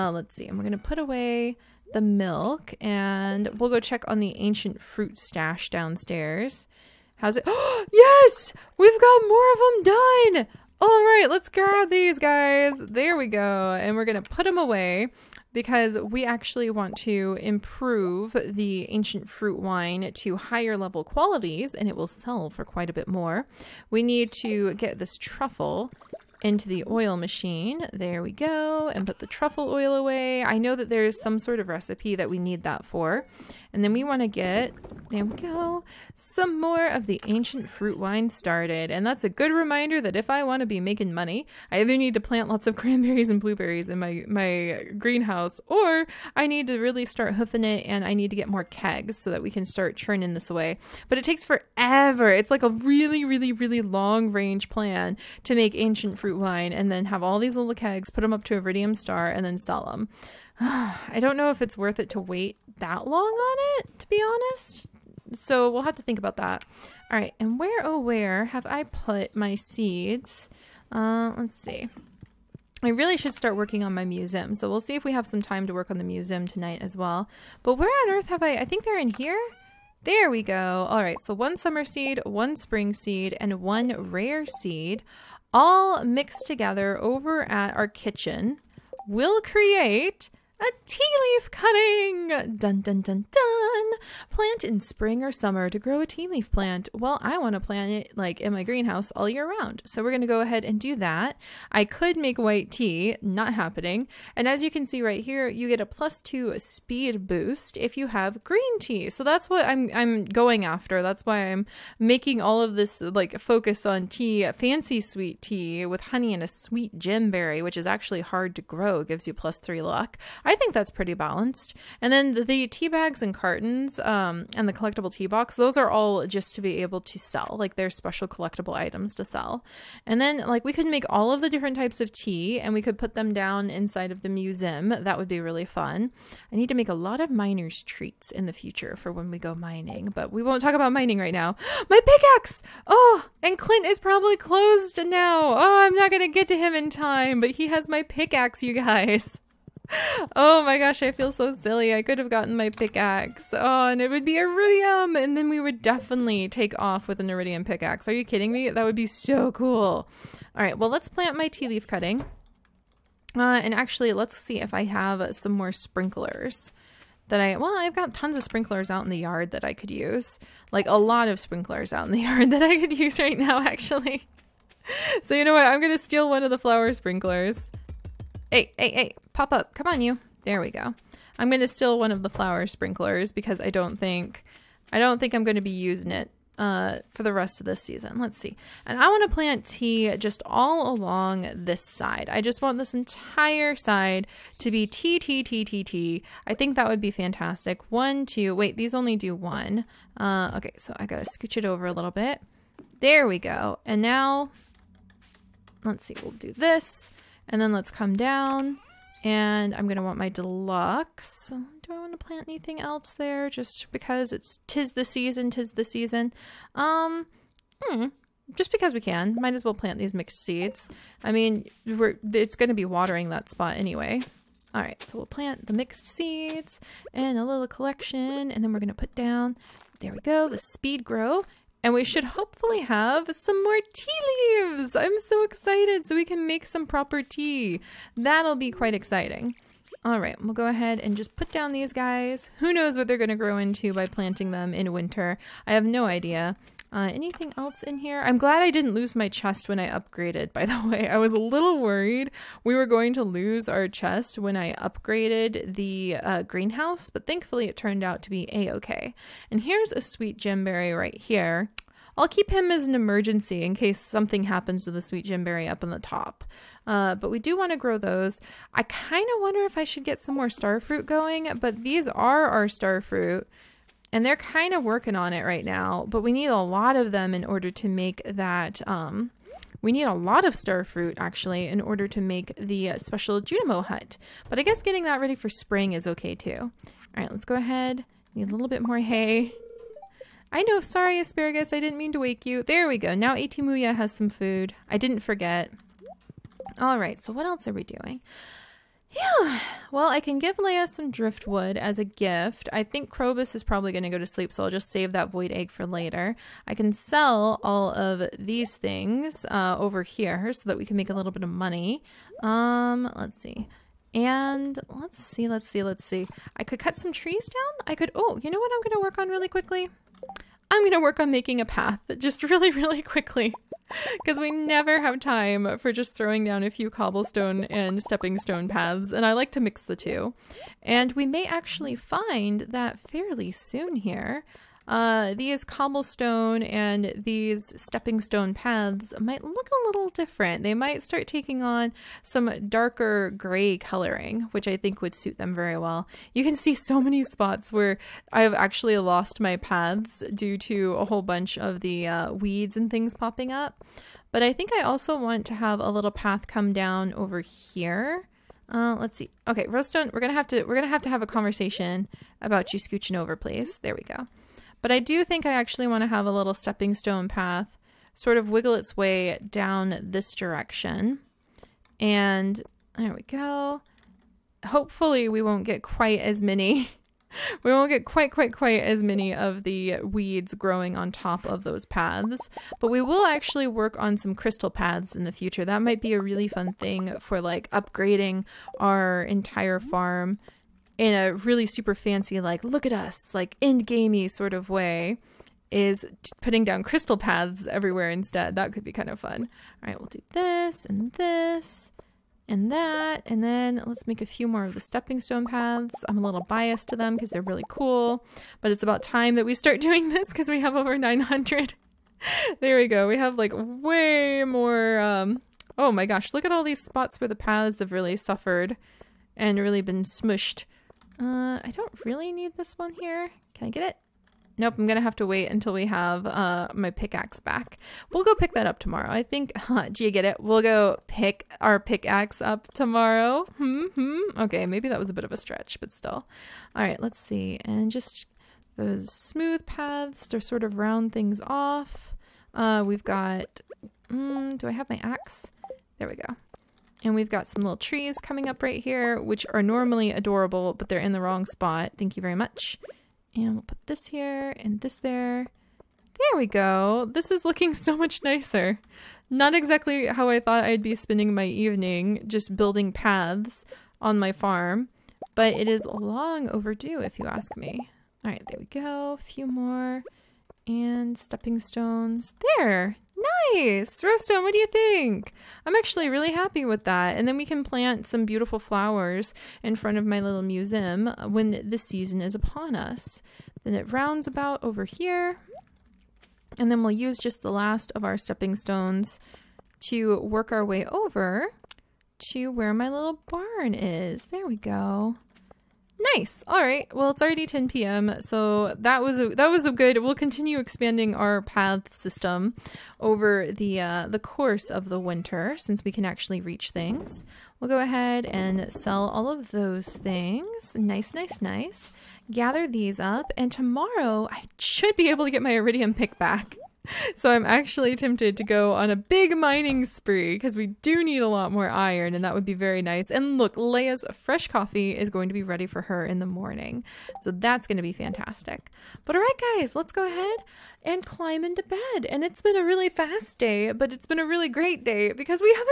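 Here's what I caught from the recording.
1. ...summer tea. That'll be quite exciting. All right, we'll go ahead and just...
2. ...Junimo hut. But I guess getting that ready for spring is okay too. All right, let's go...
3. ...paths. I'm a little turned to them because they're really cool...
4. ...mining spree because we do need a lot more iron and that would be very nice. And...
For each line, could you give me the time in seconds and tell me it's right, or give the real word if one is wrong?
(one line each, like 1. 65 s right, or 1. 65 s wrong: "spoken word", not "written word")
1. 236 s wrong: "proper", not "summer"
2. 283 s right
3. 405 s wrong: "biased", not "turned"
4. 519 s right.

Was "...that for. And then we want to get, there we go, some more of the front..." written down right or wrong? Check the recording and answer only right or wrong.
wrong.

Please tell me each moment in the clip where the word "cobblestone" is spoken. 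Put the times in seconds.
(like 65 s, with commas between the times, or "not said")
326 s, 335 s.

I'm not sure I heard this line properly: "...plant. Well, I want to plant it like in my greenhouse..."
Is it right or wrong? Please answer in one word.
right.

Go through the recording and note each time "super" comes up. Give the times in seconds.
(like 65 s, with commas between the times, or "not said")
391 s.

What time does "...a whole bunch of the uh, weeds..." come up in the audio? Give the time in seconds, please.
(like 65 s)
350 s.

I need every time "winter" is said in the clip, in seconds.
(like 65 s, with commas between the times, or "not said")
244 s, 504 s.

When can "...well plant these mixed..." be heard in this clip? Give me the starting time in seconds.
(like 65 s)
219 s.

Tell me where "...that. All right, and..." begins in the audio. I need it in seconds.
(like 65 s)
66 s.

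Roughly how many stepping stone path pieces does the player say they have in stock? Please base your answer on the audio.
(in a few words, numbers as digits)
Over 900.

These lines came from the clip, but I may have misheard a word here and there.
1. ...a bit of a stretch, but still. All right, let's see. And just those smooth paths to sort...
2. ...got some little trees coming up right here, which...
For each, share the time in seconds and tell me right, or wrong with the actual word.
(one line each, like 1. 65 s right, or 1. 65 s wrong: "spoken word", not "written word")
1. 435 s right
2. 447 s right.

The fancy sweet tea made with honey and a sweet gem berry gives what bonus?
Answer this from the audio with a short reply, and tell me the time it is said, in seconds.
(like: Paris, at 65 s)
+3 luck, at 119 s.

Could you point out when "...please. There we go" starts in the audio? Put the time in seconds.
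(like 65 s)
363 s.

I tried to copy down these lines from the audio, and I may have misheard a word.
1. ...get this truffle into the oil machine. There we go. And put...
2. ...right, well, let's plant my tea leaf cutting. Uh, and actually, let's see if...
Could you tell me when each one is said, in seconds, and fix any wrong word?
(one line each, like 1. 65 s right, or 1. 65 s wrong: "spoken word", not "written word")
1. 24 s right
2. 160 s right.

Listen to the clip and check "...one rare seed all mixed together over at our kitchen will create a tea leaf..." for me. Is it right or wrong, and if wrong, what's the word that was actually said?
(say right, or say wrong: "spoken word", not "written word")
right.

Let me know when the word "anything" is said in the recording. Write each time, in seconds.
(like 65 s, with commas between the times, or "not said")
212 s, 247 s.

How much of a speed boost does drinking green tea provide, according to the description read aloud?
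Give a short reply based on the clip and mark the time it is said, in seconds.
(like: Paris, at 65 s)
+2, at 105 s.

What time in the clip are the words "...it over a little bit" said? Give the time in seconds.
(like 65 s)
201 s.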